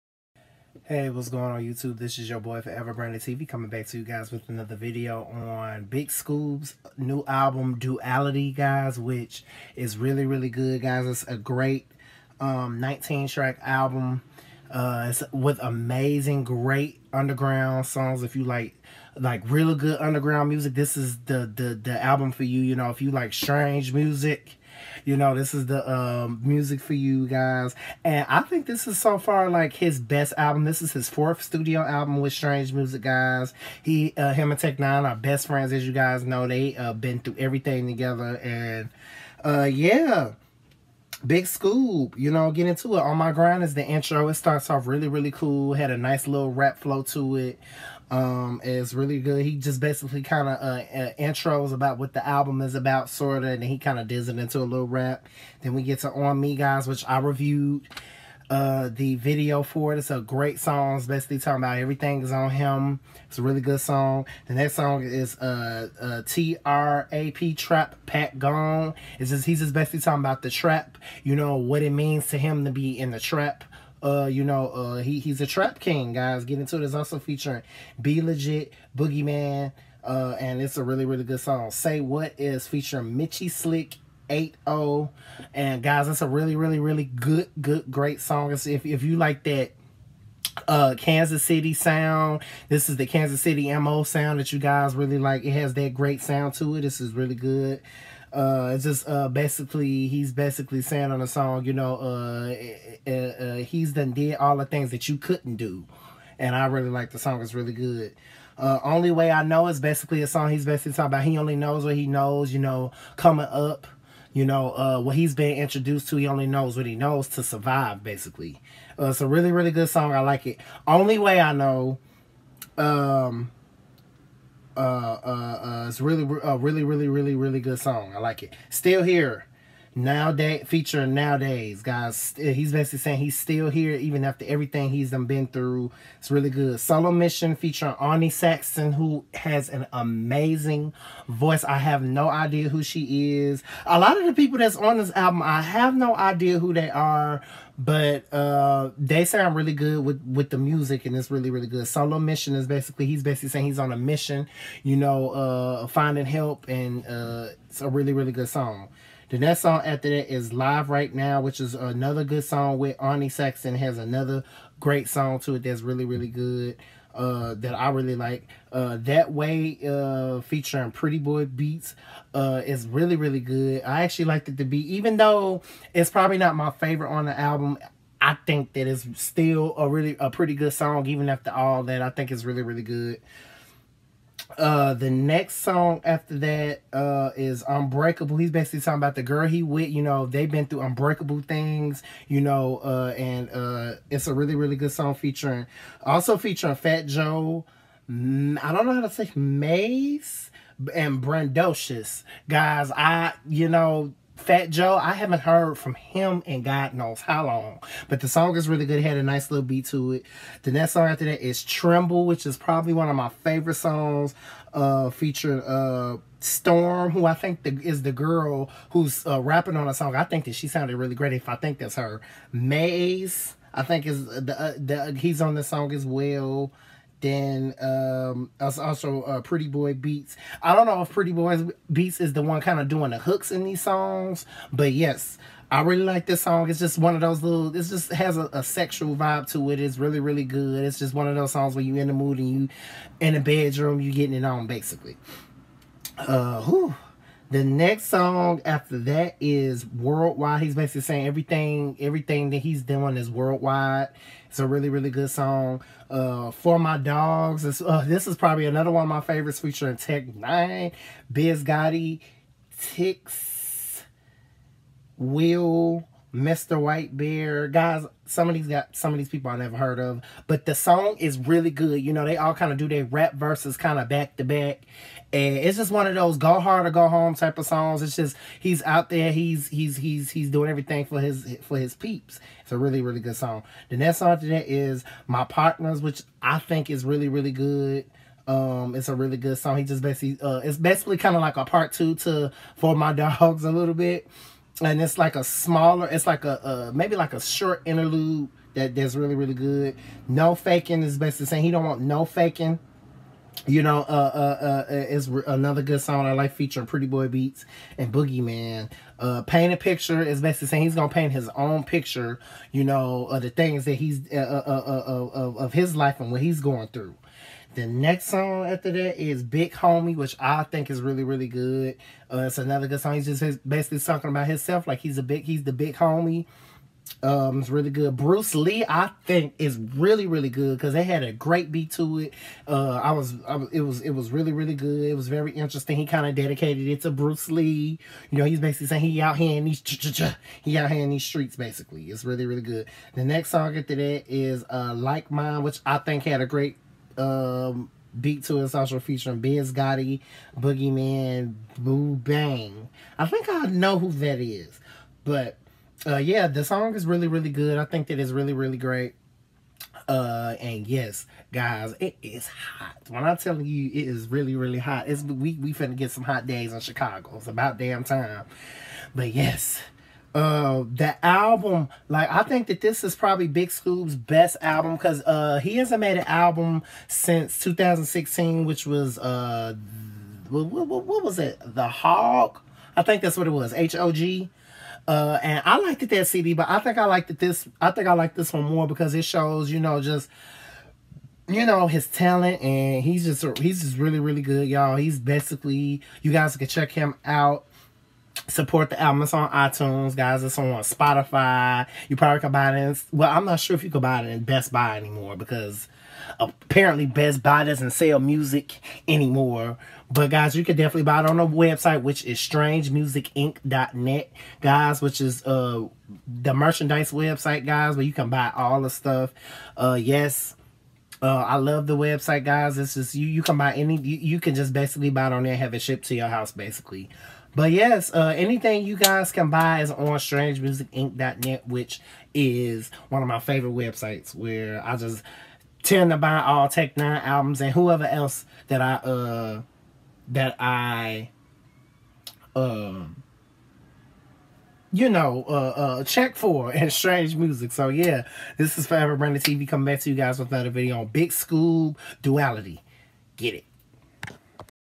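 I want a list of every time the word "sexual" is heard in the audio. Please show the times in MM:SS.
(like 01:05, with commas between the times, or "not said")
03:58.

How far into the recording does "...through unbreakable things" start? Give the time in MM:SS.
03:10.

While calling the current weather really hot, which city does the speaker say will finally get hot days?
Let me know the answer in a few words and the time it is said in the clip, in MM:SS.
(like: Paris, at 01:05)
Chicago, at 06:06.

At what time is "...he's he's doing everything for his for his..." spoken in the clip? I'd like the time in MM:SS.
04:39.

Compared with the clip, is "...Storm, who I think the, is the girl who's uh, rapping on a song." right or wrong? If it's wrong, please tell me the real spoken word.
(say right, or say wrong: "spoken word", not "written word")
right.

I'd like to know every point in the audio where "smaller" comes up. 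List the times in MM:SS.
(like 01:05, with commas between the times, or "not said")
04:55.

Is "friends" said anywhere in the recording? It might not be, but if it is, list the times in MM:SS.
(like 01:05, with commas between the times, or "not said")
00:35.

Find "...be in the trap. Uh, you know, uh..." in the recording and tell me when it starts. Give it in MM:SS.
01:12.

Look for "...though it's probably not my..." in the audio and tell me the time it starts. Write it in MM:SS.
02:55.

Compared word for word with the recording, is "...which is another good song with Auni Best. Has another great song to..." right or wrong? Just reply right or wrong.
wrong.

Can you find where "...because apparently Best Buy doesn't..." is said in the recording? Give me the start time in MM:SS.
06:45.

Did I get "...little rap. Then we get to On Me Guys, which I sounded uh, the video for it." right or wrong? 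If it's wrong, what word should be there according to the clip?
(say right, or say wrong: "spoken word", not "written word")
wrong: "reviewed", not "sounded".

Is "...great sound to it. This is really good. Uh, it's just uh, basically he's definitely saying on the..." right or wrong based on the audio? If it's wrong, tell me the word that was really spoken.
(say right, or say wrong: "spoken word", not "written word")
wrong: "basically", not "definitely".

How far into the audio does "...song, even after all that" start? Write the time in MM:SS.
03:00.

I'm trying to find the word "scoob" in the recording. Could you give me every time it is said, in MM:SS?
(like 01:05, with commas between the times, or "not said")
00:06, 00:41, 06:13, 07:31.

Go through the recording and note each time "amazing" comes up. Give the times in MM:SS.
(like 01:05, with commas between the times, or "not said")
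00:15, 02:19.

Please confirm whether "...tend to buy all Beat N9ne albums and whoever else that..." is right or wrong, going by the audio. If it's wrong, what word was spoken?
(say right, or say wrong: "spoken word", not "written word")
wrong: "Tech", not "Beat".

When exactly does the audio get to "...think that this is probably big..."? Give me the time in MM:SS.
06:12.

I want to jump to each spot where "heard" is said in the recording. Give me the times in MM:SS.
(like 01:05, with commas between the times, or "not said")
03:25, 04:29.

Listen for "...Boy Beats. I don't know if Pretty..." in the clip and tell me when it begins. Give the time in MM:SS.
03:49.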